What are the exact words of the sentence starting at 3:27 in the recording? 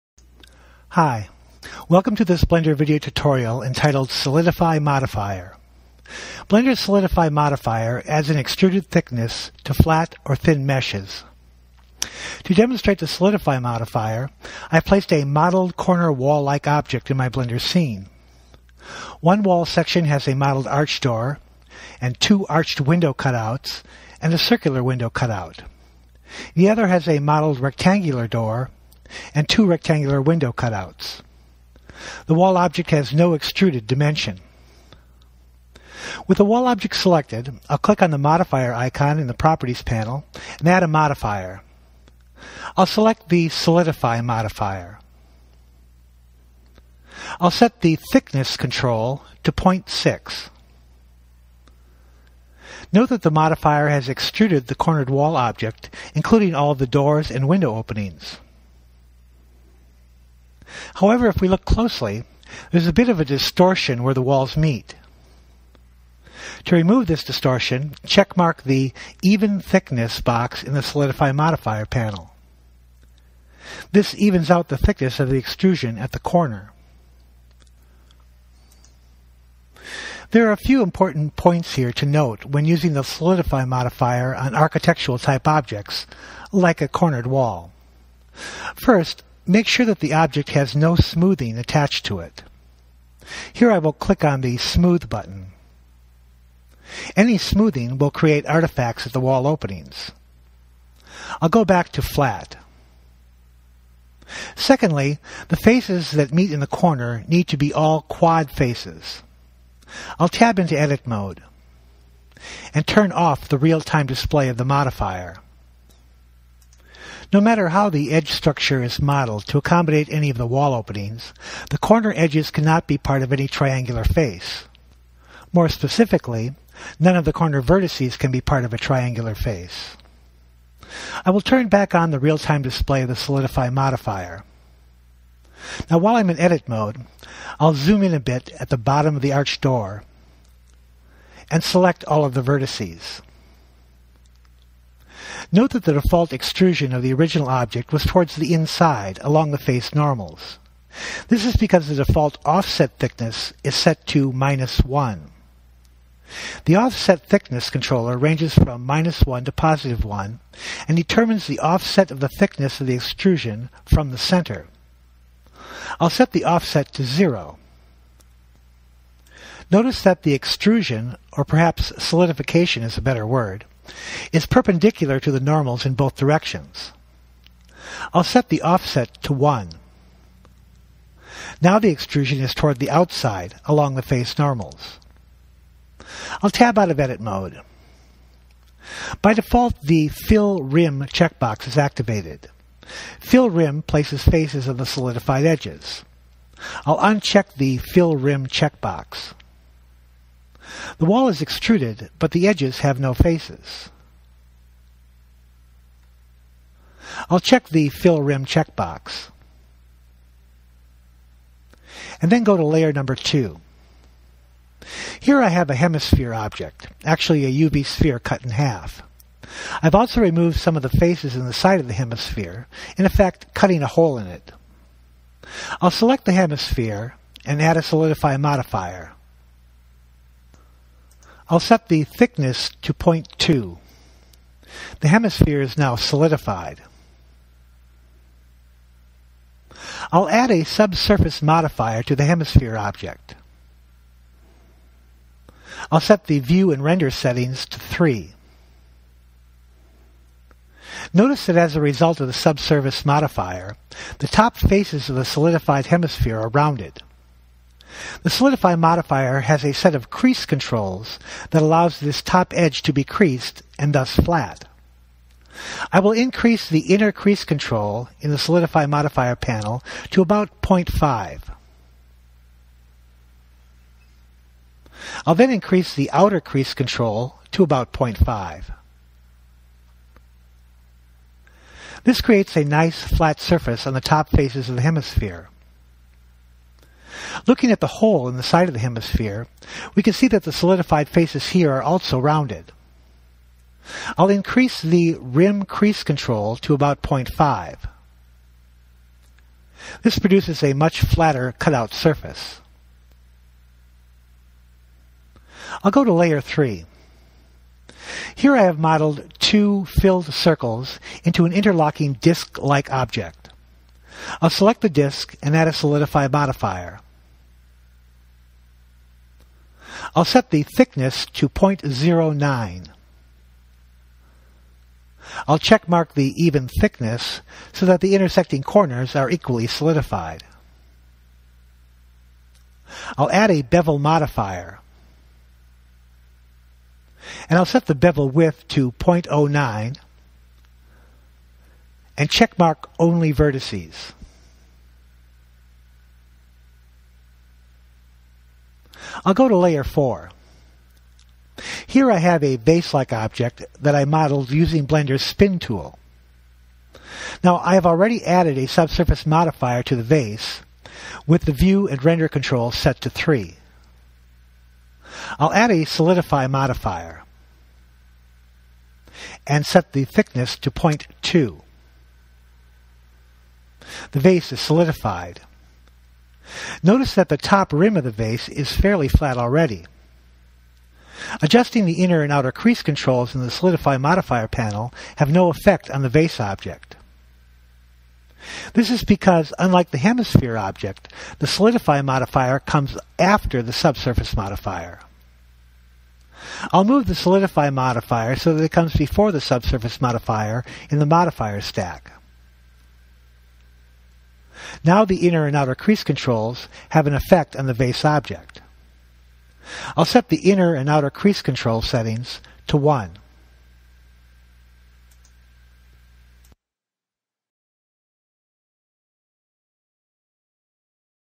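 I'll check the Fill Rim checkbox.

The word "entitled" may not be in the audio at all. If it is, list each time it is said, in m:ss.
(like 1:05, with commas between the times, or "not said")
0:03.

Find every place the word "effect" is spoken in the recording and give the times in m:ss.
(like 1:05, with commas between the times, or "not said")
3:43, 6:25, 6:47.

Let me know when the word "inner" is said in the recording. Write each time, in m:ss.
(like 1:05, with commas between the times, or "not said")
4:26, 6:22, 6:45, 6:50.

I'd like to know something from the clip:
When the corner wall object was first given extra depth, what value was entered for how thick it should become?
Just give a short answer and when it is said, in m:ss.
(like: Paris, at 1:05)
0.6, at 0:49.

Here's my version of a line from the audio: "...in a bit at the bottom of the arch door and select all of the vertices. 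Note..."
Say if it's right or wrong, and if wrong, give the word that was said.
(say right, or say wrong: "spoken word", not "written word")
right.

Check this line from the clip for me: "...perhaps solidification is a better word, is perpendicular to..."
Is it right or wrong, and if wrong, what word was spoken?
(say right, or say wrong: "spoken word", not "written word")
right.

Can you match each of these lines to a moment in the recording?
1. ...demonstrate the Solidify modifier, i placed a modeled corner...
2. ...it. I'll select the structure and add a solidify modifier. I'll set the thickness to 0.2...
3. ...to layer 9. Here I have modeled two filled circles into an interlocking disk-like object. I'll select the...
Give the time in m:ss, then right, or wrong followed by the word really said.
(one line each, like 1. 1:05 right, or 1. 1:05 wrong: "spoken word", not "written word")
1. 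0:12 right
2. 3:44 wrong: "hemisphere", not "structure"
3. 5:06 wrong: "3", not "9".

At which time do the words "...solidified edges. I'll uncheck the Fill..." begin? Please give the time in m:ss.
3:14.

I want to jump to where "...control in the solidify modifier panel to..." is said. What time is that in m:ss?
4:27.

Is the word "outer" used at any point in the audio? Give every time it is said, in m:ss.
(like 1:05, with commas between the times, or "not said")
4:36, 6:22, 6:45, 6:50.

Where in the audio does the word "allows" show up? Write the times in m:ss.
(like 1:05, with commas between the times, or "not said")
4:21.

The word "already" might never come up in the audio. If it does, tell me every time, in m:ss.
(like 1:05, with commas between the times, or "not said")
5:57, 6:19.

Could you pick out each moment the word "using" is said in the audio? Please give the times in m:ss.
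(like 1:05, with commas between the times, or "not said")
1:22, 5:54.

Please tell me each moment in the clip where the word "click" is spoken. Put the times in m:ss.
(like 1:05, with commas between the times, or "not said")
0:37, 1:33.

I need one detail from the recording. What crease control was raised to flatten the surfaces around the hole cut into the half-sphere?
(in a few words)
rim crease.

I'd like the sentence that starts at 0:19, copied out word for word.
One wall section has a modeled arch door, and two arched window cutouts, and a circular window cutout.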